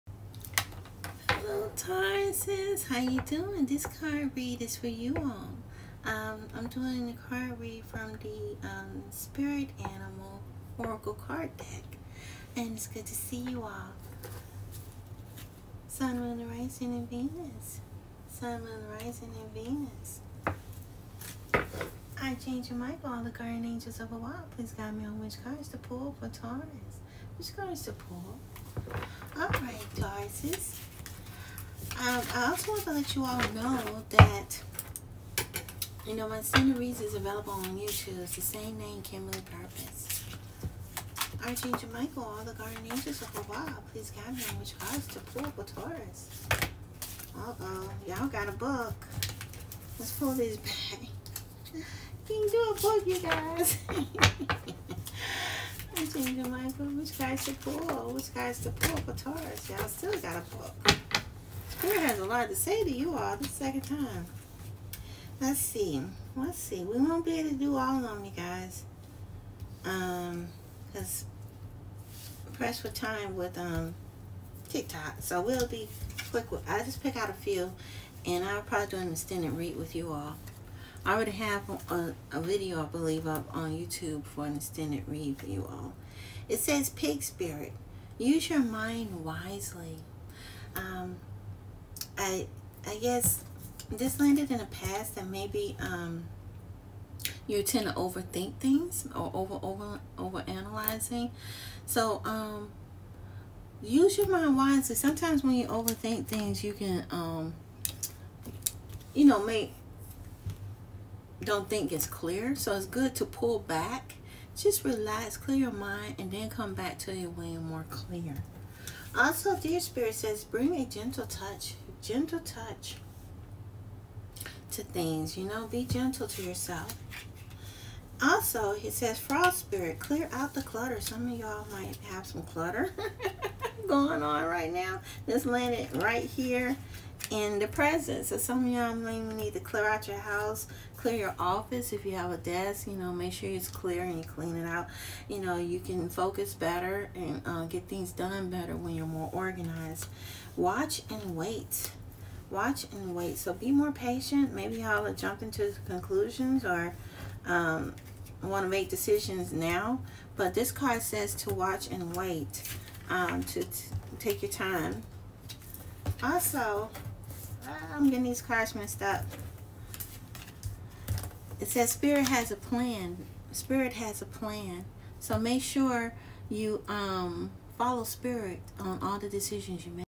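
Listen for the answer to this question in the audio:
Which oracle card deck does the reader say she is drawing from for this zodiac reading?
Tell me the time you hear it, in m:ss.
0:09.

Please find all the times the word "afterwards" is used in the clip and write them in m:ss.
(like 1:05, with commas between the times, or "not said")
not said.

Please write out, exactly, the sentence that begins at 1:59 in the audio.
Also, deer spirit says, bring a gentle touch, gentle touch to things.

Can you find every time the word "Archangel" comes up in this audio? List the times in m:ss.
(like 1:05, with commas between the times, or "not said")
0:22, 0:41, 0:55.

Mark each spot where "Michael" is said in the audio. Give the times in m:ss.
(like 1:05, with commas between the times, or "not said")
0:22, 0:41, 0:56.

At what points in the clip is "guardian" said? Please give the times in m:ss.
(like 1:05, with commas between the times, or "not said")
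0:23, 0:42.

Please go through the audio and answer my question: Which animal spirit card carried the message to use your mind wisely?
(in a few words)
Pig.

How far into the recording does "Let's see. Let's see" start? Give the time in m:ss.
1:05.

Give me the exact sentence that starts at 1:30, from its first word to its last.
Um, I, I guess this landed in a past that maybe um, you tend to overthink things or over over over analyzing.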